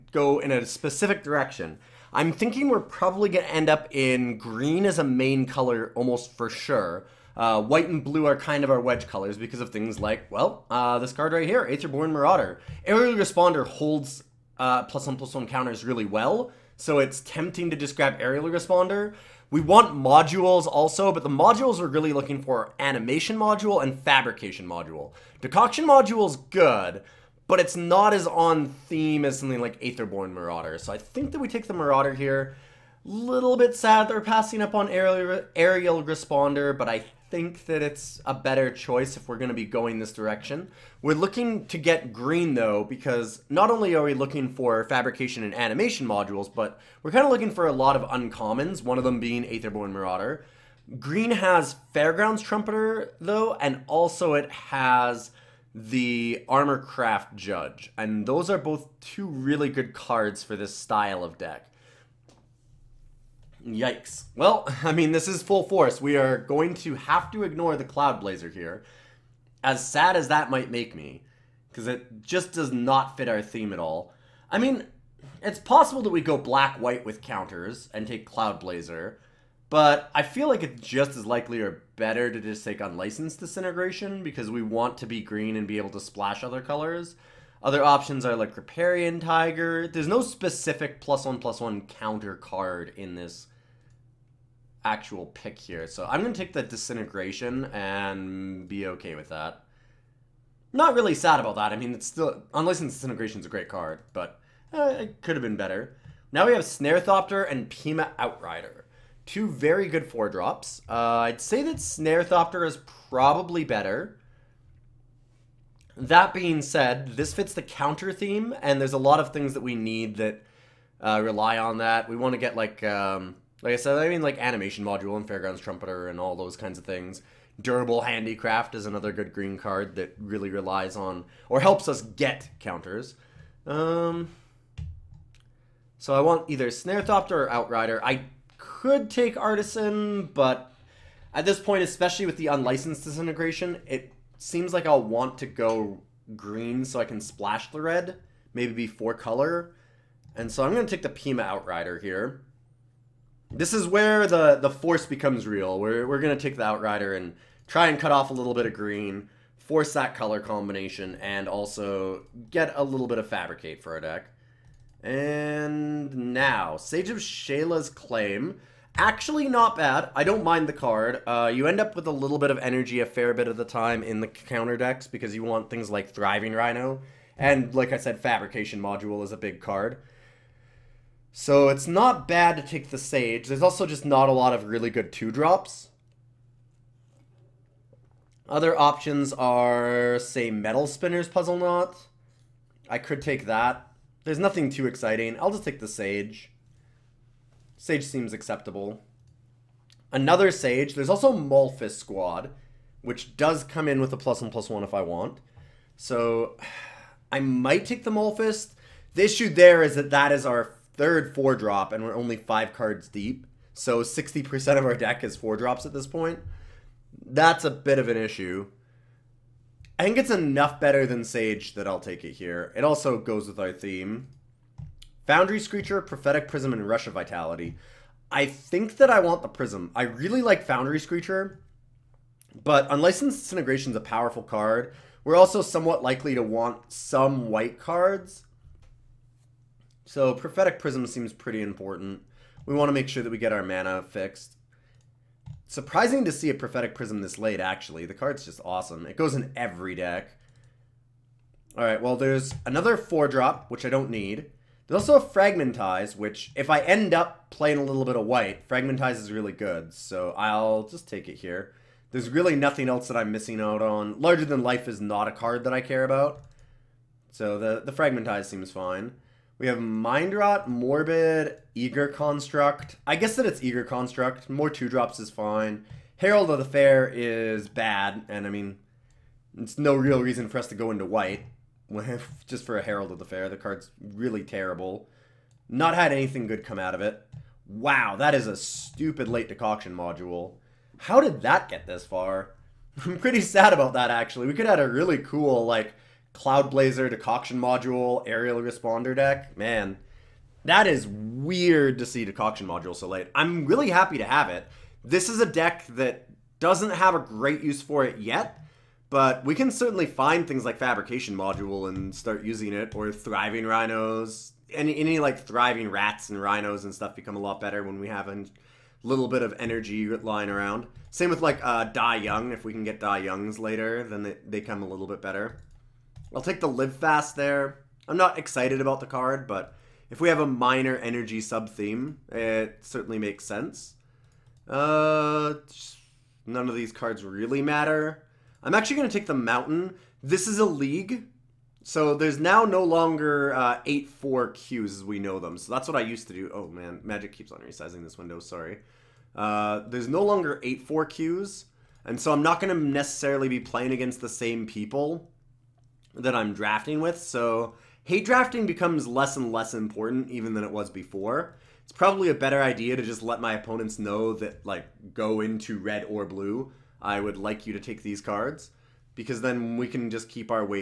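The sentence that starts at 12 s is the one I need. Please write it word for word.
Aerial Responder holds uh, plus one plus one counters really well.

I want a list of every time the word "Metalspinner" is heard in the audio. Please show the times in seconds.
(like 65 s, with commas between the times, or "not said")
190 s.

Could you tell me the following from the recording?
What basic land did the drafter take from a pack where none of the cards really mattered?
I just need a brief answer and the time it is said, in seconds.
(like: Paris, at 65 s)
Mountain, at 339 s.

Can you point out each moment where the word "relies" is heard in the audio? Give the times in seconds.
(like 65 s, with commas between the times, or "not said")
130 s.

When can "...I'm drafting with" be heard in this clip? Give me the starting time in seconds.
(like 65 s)
356 s.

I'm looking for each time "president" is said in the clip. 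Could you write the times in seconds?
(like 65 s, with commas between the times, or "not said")
not said.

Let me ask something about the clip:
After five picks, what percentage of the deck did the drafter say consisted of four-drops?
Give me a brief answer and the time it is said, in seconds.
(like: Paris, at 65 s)
60%, at 214 s.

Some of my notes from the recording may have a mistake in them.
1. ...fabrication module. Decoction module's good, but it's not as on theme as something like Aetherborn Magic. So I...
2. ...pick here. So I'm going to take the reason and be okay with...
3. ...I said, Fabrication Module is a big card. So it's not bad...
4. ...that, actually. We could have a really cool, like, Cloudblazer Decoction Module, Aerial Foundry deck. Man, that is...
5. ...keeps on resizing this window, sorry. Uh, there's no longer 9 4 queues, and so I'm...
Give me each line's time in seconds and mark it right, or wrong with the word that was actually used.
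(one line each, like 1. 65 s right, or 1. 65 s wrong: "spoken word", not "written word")
1. 24 s wrong: "Marauder", not "Magic"
2. 95 s wrong: "disintegration", not "reason"
3. 177 s right
4. 293 s wrong: "Responder", not "Foundry"
5. 347 s wrong: "8", not "9".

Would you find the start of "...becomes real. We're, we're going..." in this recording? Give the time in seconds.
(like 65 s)
155 s.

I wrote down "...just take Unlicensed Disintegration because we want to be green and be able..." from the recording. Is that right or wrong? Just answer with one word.
right.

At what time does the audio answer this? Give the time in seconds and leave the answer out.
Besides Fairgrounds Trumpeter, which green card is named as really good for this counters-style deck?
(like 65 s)
56 s.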